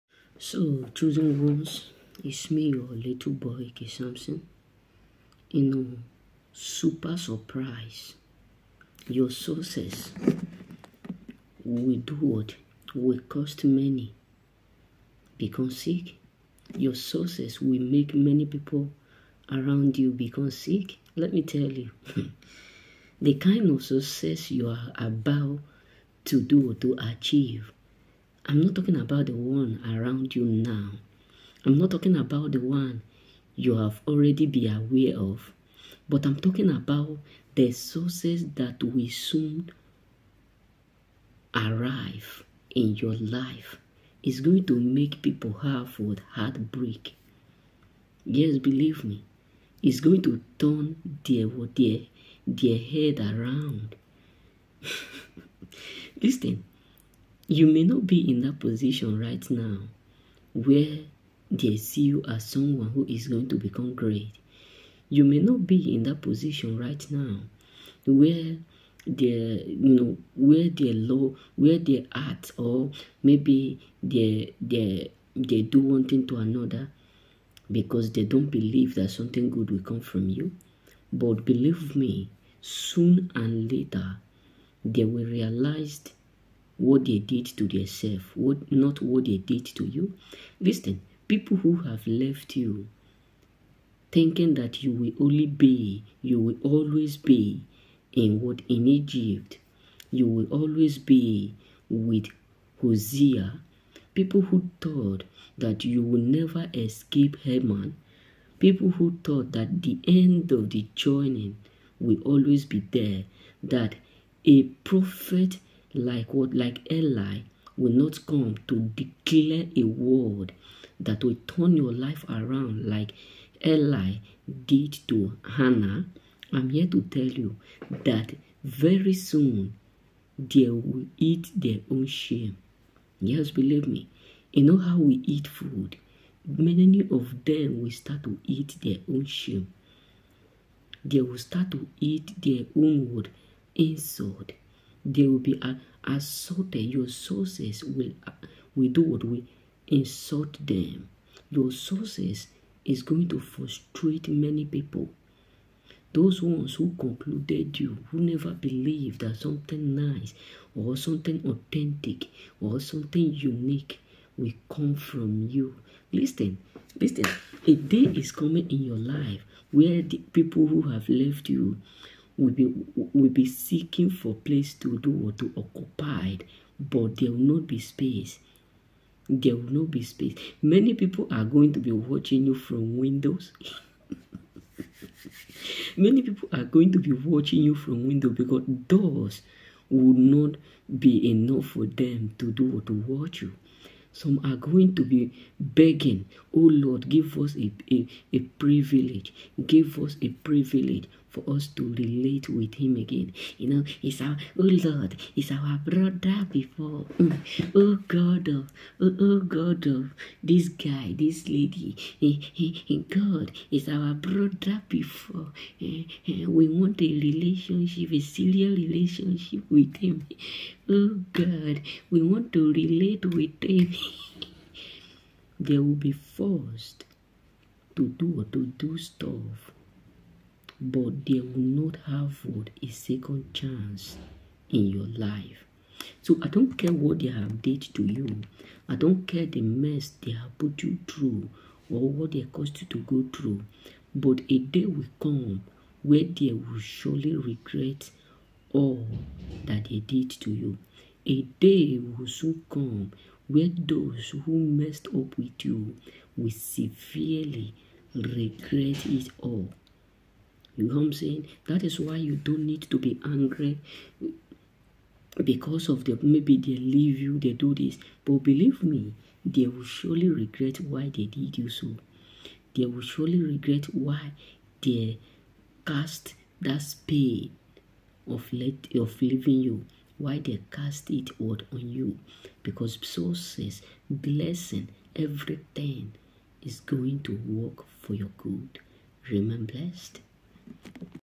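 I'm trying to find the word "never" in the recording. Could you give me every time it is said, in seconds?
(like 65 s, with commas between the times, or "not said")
106 s, 158 s.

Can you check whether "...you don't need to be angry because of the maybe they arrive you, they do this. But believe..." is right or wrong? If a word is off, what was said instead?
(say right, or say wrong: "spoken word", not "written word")
wrong: "leave", not "arrive".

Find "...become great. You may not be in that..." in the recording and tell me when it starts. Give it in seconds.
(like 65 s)
63 s.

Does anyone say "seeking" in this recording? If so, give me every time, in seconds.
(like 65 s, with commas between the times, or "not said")
173 s.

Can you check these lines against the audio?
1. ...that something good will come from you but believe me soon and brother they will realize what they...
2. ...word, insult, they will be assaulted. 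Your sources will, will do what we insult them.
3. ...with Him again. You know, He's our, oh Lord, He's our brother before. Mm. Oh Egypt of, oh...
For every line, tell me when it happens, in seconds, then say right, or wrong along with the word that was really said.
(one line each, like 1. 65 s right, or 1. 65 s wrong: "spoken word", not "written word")
1. 78 s wrong: "later", not "brother"
2. 143 s right
3. 202 s wrong: "God", not "Egypt".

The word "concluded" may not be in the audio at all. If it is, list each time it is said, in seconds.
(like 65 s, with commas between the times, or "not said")
156 s.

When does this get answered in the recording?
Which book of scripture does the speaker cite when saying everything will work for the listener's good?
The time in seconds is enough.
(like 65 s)
283 s.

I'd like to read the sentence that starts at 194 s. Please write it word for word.
Some are going to be begging, Oh Lord, give us a, a, a privilege.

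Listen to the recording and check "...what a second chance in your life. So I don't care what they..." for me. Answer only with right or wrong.
right.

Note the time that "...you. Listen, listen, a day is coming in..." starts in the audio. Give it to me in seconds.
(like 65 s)
165 s.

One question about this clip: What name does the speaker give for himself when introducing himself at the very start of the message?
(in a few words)
K. Samson.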